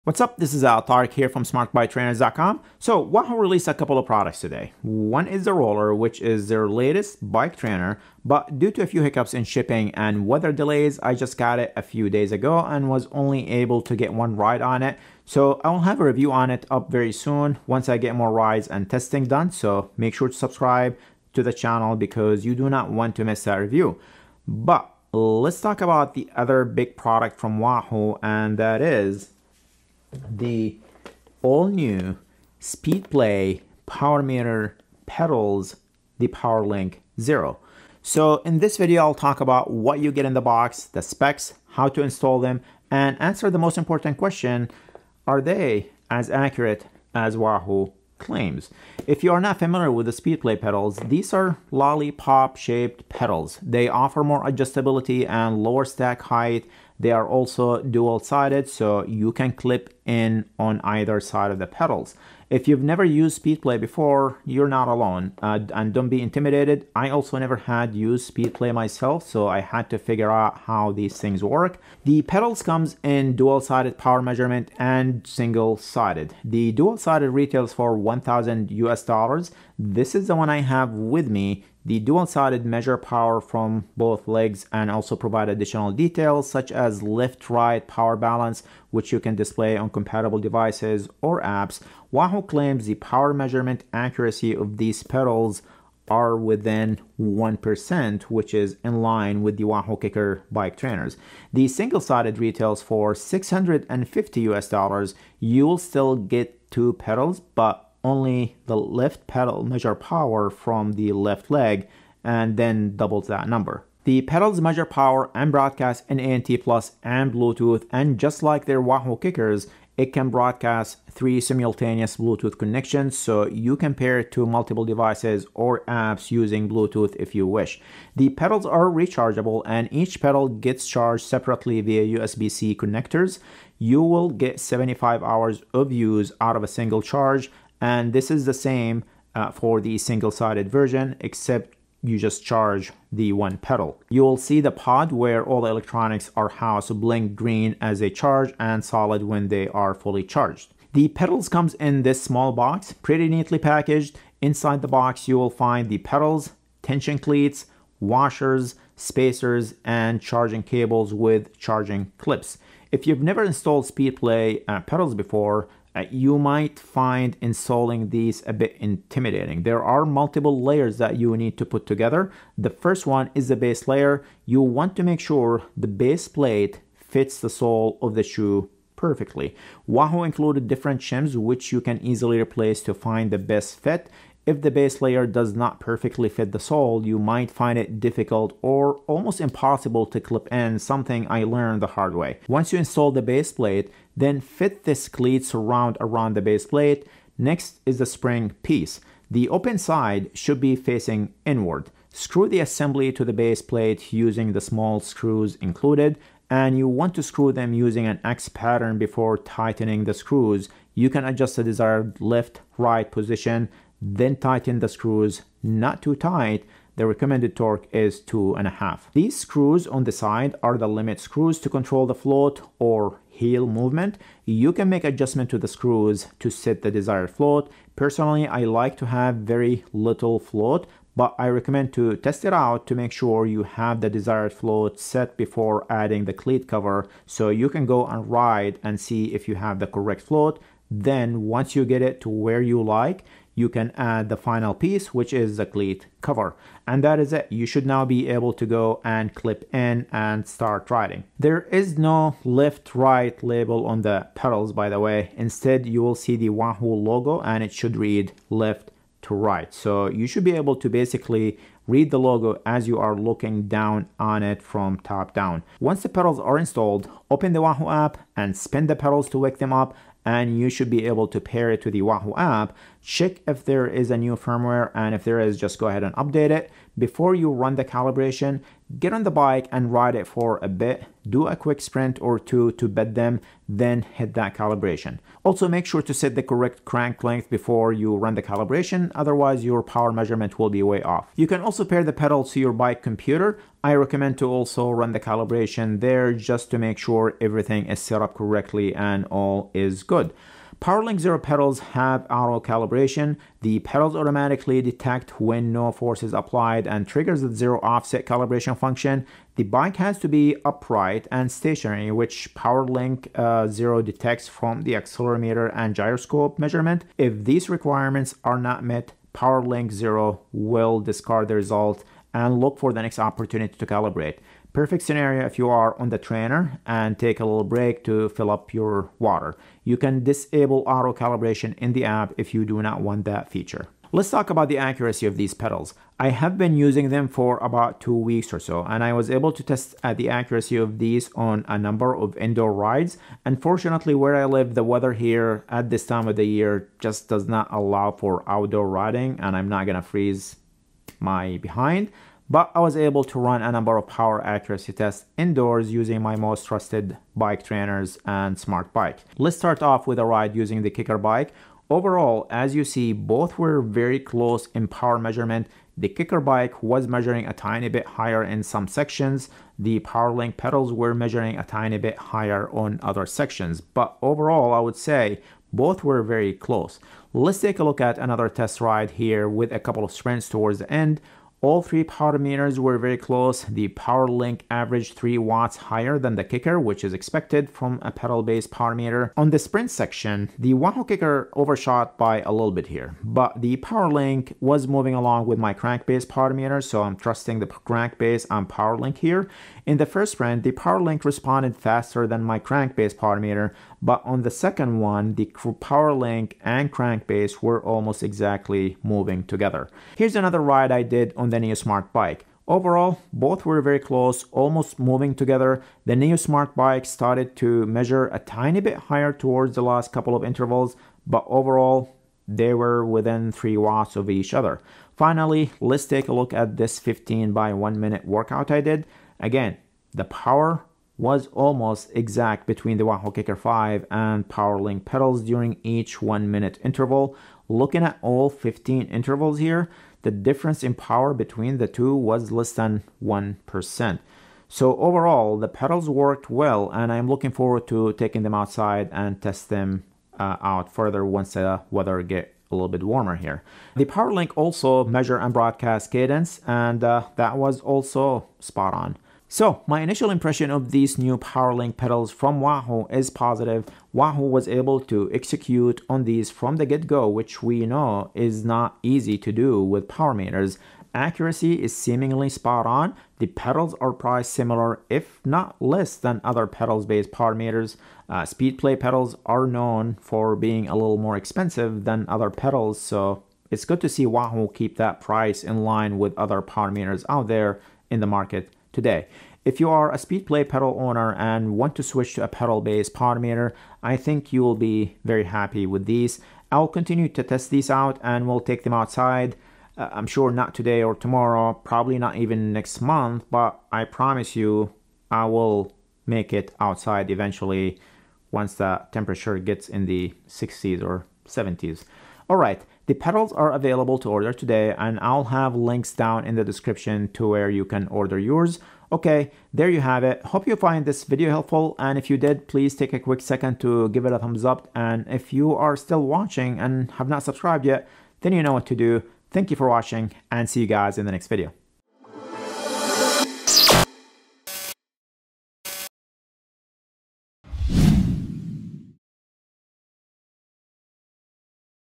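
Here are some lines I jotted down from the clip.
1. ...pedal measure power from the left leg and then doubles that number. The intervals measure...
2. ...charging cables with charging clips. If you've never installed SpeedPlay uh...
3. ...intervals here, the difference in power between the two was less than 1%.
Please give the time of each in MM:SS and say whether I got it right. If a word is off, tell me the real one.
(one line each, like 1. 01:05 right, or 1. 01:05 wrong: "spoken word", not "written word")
1. 01:49 wrong: "pedals", not "intervals"
2. 02:40 right
3. 07:19 right.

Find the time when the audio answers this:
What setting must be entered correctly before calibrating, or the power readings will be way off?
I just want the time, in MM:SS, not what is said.
04:46.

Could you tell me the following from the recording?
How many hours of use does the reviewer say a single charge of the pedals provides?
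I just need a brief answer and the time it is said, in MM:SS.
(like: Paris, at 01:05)
75 hours, at 02:14.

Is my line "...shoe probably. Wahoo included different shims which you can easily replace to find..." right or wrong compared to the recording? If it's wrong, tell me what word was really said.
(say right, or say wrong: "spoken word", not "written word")
wrong: "perfectly", not "probably".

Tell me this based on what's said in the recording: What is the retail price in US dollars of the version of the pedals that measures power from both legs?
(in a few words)
1,000 US dollars.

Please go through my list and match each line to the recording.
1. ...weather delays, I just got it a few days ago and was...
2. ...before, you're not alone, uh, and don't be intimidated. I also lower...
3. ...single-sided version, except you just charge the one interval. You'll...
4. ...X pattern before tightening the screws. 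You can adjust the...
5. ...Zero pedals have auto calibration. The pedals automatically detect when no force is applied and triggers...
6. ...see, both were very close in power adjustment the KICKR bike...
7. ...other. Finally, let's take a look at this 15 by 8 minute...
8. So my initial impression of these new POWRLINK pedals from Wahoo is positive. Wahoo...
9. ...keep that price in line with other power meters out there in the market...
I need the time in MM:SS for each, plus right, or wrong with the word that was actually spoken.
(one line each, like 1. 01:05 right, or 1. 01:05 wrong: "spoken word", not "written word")
1. 00:10 right
2. 01:03 wrong: "never", not "lower"
3. 02:19 wrong: "pedal", not "interval"
4. 03:28 right
5. 05:01 right
6. 06:02 wrong: "measurement", not "adjustment"
7. 07:04 wrong: "1", not "8"
8. 07:39 right
9. 08:04 right.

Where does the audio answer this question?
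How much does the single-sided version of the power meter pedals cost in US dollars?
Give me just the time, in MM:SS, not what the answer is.
01:43.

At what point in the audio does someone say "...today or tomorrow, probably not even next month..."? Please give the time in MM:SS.
08:20.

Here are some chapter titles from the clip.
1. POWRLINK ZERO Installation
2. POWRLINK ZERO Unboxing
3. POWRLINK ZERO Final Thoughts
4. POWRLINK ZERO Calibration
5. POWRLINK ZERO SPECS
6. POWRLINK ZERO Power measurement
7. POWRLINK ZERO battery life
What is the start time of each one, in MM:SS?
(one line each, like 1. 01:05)
1. 02:42
2. 02:30
3. 07:38
4. 04:11
5. 01:11
6. 05:33
7. 02:07.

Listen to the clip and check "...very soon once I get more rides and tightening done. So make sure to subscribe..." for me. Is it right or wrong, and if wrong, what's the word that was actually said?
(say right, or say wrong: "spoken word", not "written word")
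wrong: "testing", not "tightening".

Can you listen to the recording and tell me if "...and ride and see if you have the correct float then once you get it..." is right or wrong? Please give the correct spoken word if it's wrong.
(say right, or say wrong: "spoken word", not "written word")
right.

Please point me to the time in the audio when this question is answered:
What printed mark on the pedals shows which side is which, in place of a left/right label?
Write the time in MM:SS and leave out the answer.
04:16.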